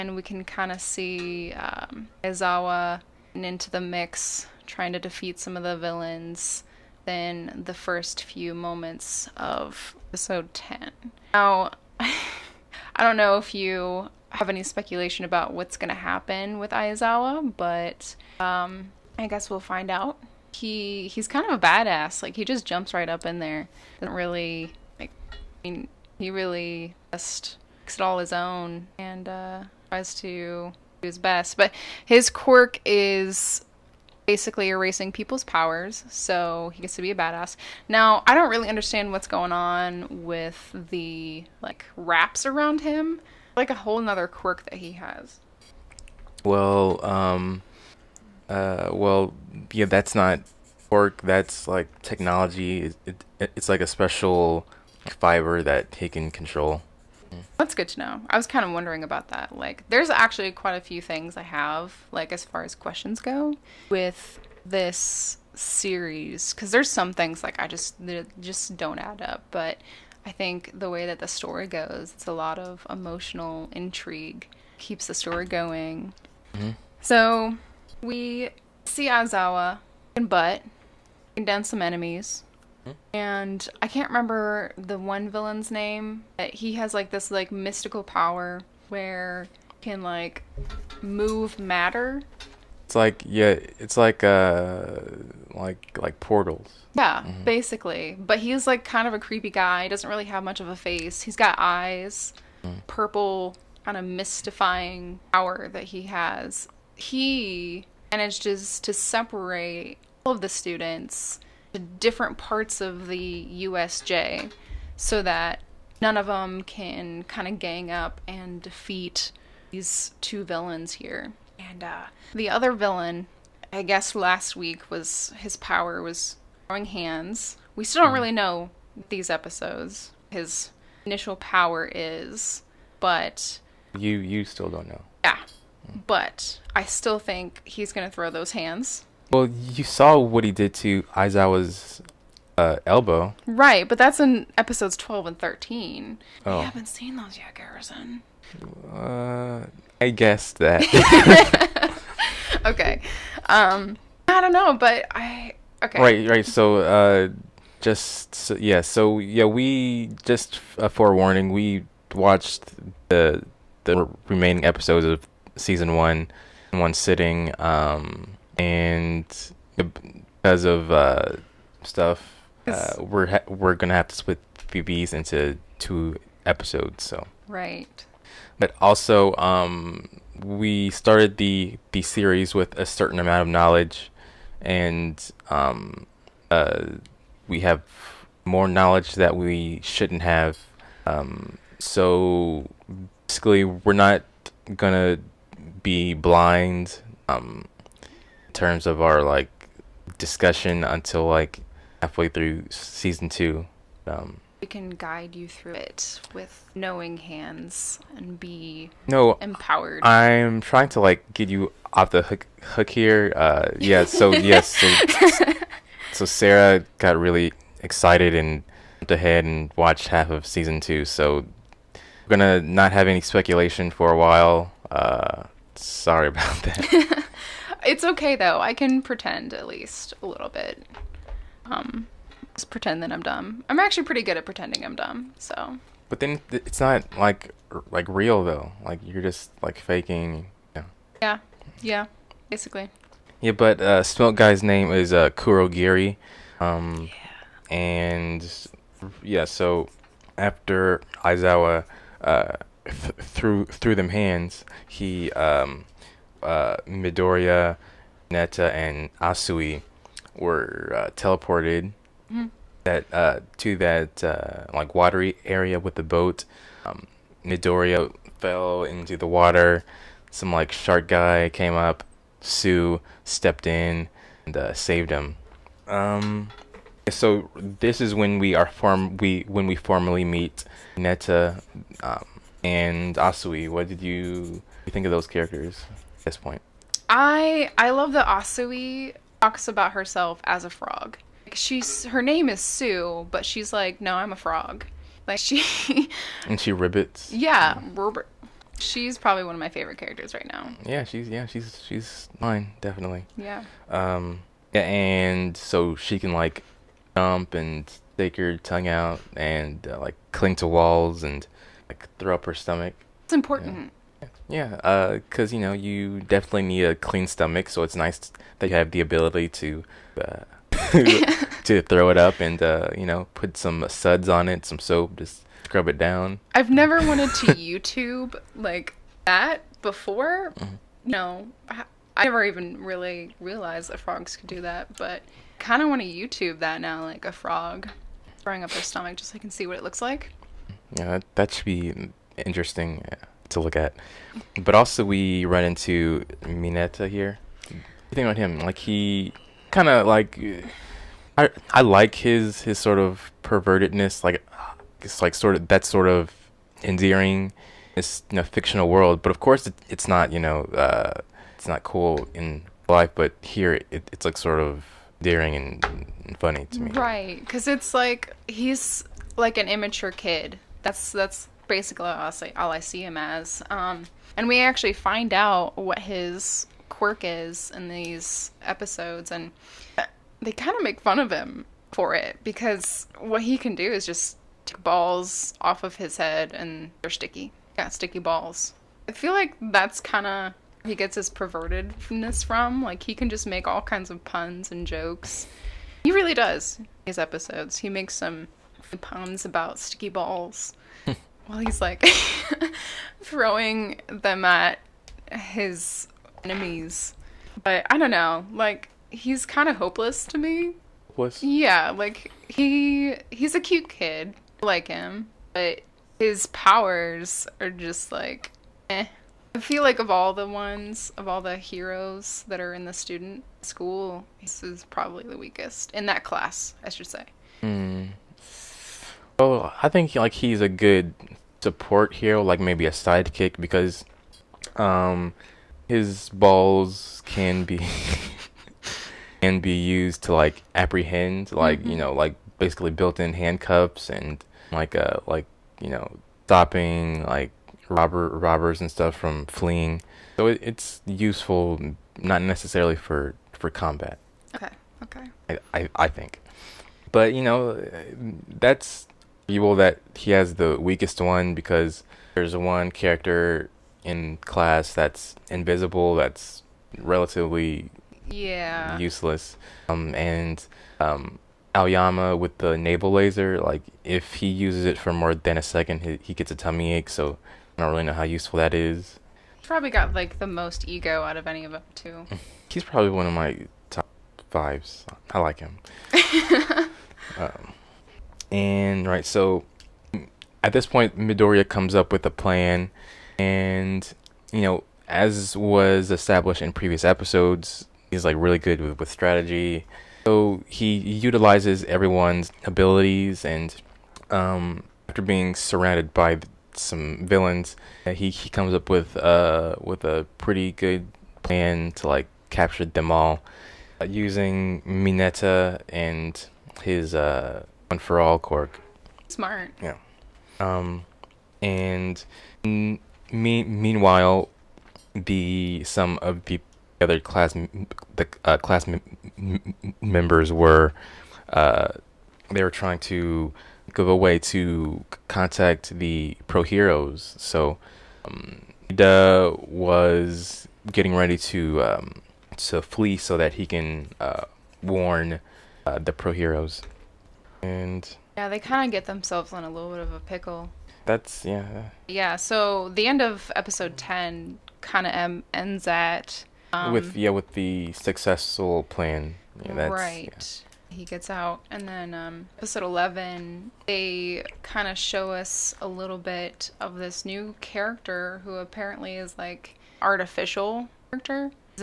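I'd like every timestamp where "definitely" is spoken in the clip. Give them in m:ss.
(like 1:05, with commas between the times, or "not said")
5:02, 5:16.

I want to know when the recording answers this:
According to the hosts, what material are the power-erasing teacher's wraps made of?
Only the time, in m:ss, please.
0:53.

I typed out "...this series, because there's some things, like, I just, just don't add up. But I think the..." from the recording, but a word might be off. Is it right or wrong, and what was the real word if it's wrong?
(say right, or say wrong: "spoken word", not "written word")
right.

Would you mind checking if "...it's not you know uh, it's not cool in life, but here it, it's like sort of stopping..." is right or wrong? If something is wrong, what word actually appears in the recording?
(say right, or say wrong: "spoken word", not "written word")
wrong: "daring", not "stopping".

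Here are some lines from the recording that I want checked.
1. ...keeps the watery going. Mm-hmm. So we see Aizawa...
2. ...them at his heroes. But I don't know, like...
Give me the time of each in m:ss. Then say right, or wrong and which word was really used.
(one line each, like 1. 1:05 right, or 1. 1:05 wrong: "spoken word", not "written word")
1. 1:14 wrong: "story", not "watery"
2. 6:44 wrong: "enemies", not "heroes".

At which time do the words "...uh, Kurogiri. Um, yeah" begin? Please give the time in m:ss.
4:05.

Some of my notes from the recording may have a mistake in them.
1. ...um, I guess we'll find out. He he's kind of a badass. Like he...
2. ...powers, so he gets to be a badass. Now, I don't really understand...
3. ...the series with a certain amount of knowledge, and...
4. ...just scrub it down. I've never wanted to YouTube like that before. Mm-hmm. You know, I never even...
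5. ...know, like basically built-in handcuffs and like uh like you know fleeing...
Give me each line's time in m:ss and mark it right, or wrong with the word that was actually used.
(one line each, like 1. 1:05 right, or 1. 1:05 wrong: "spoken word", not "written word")
1. 0:18 right
2. 0:35 right
3. 3:01 right
4. 5:25 right
5. 7:21 wrong: "stopping", not "fleeing".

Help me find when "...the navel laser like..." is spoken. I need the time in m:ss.
7:52.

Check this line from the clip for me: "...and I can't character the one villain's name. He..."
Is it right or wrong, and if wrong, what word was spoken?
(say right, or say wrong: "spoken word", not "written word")
wrong: "remember", not "character".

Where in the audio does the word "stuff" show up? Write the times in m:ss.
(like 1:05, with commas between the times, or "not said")
2:51, 7:28.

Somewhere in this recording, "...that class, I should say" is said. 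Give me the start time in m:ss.
7:06.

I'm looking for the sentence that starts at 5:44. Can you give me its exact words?
But also, we run into Mineta here.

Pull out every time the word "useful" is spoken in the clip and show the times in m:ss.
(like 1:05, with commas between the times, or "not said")
7:31, 7:58.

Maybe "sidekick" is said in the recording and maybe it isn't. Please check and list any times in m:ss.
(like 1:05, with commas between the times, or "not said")
7:12.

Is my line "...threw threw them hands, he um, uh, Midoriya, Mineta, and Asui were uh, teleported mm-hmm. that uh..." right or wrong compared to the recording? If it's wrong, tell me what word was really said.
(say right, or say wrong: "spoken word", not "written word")
right.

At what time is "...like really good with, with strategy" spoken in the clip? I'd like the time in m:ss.
8:18.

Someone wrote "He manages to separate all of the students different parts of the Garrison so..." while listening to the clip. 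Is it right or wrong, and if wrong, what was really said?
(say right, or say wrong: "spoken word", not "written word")
wrong: "USJ", not "Garrison".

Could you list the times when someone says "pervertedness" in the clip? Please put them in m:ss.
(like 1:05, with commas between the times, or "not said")
5:53, 6:31.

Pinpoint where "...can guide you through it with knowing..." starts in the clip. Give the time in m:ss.
3:24.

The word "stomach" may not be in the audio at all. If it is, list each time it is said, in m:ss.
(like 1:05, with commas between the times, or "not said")
5:12, 5:17, 5:38.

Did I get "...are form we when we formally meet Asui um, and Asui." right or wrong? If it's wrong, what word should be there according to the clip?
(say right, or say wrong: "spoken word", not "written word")
wrong: "Mineta", not "Asui".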